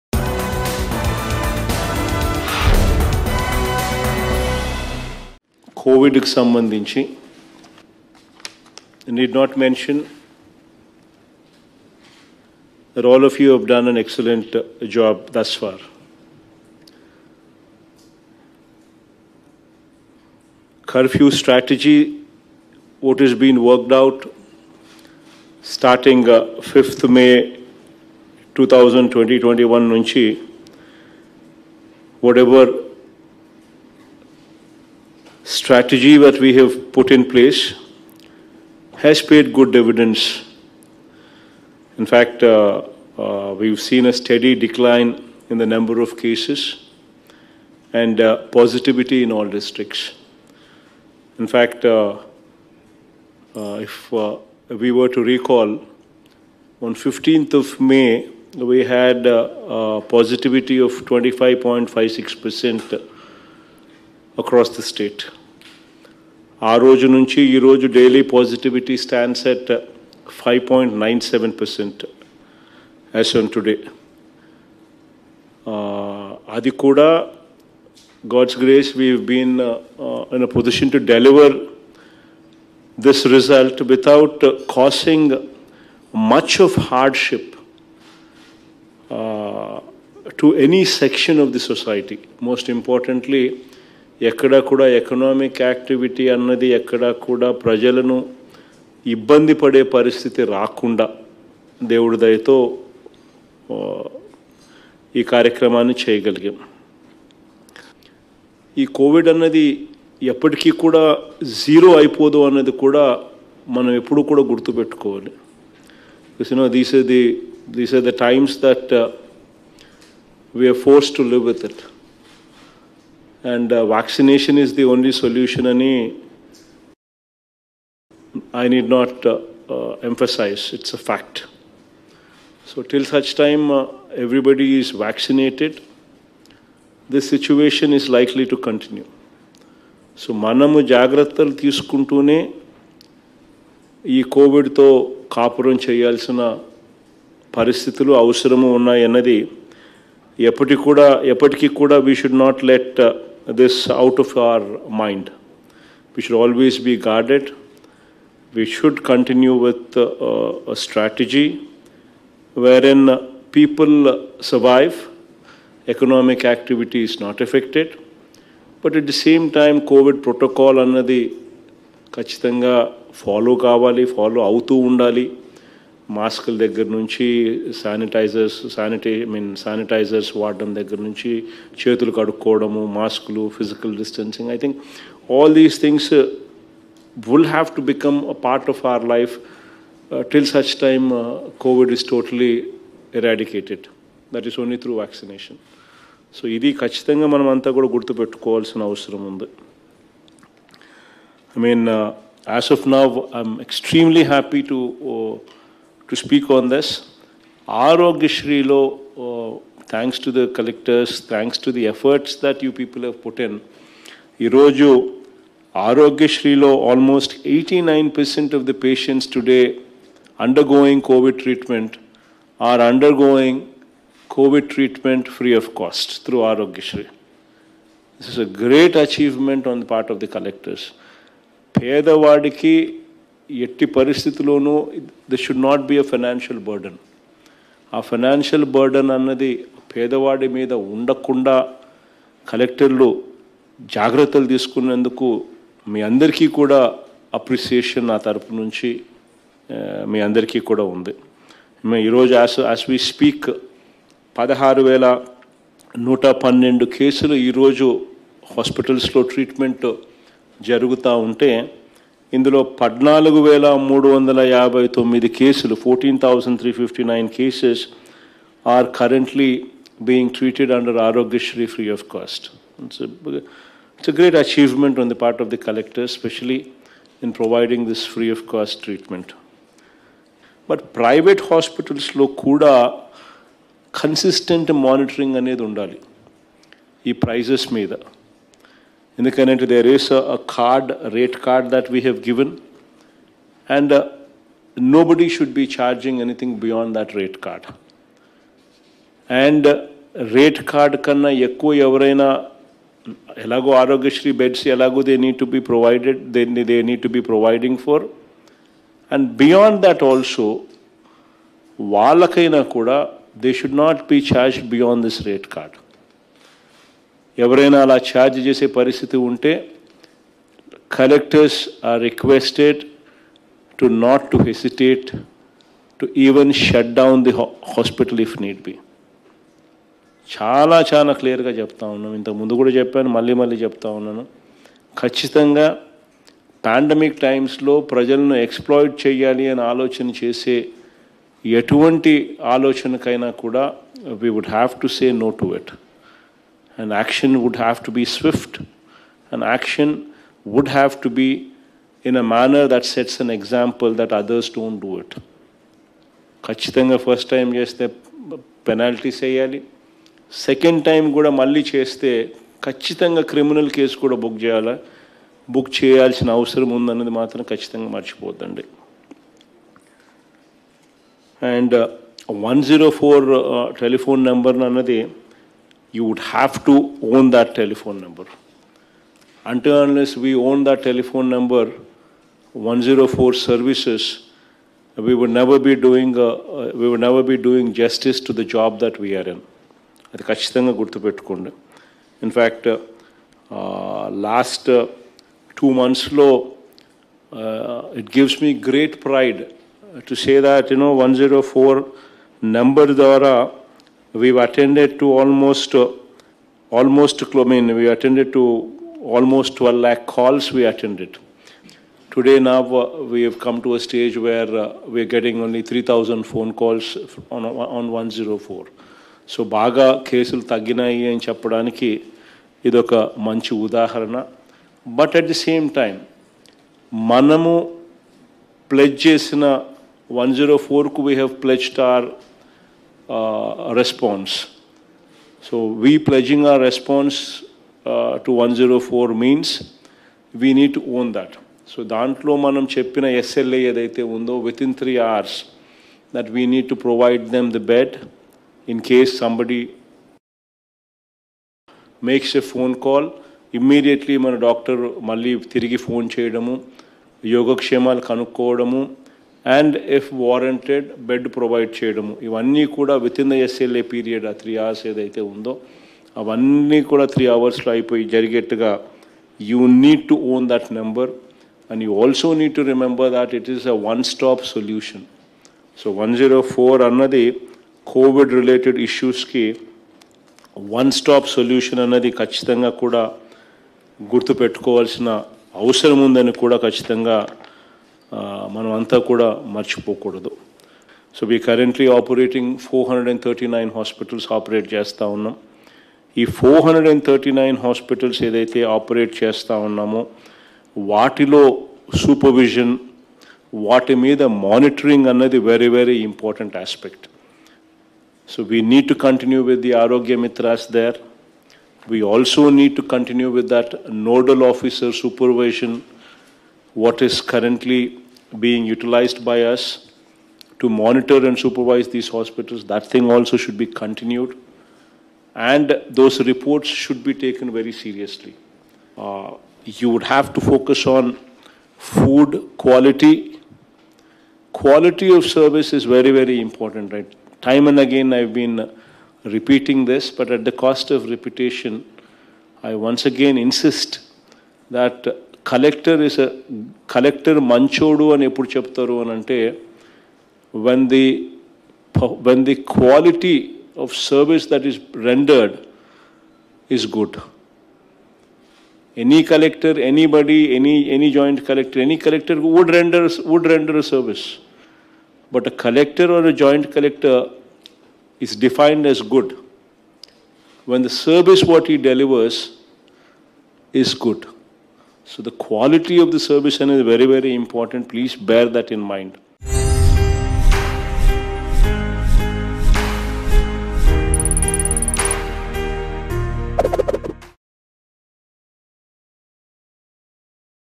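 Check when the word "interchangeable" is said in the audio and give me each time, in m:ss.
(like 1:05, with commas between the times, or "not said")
not said.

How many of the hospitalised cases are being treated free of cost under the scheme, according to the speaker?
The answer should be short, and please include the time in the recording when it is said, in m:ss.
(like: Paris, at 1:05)
14359, at 4:25.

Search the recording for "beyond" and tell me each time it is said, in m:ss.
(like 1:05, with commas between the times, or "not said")
4:56, 5:09, 5:14.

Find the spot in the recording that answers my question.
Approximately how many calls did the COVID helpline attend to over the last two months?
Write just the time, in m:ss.
6:49.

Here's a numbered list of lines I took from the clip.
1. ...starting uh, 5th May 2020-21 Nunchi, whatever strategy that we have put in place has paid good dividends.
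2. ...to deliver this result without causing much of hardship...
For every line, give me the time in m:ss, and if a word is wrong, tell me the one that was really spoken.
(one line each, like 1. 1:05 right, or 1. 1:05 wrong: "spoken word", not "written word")
1. 0:25 right
2. 1:20 right.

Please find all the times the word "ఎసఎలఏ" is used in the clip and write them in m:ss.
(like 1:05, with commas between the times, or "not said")
7:23, 7:43.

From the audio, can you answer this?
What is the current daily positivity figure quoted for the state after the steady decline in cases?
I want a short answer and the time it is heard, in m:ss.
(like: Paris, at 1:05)
5.97%, at 1:10.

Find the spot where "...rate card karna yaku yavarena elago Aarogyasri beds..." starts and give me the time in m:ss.
5:00.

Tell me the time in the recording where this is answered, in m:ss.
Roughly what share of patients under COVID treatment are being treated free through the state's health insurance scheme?
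3:37.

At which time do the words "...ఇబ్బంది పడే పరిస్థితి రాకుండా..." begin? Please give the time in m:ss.
1:39.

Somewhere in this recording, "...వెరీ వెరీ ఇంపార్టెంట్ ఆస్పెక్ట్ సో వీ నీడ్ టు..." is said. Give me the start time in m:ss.
8:25.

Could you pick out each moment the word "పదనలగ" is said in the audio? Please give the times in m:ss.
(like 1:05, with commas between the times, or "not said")
4:22.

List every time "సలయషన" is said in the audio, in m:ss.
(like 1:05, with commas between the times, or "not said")
2:05, 7:54, 8:01.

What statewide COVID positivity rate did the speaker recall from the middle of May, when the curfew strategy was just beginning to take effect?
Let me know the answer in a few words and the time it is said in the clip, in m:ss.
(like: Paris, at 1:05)
25.56%, at 1:00.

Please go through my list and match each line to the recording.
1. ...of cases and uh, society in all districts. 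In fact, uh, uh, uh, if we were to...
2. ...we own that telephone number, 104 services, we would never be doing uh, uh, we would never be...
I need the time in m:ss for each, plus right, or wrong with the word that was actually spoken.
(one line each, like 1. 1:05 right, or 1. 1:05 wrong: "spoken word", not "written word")
1. 0:45 wrong: "positivity", not "society"
2. 6:20 right.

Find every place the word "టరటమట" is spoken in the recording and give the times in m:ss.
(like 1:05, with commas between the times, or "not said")
4:19, 4:38.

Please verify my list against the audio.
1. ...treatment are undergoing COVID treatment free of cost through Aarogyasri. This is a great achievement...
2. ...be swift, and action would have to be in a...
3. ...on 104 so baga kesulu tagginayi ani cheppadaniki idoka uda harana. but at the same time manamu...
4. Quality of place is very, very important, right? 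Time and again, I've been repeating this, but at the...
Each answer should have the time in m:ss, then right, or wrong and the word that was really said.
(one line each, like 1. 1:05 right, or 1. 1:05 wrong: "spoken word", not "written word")
1. 3:41 right
2. 5:47 right
3. 6:57 right
4. 8:54 wrong: "service", not "place".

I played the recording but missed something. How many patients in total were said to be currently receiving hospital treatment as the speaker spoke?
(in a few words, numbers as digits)
16112.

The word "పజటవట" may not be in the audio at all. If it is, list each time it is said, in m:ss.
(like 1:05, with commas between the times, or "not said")
1:08.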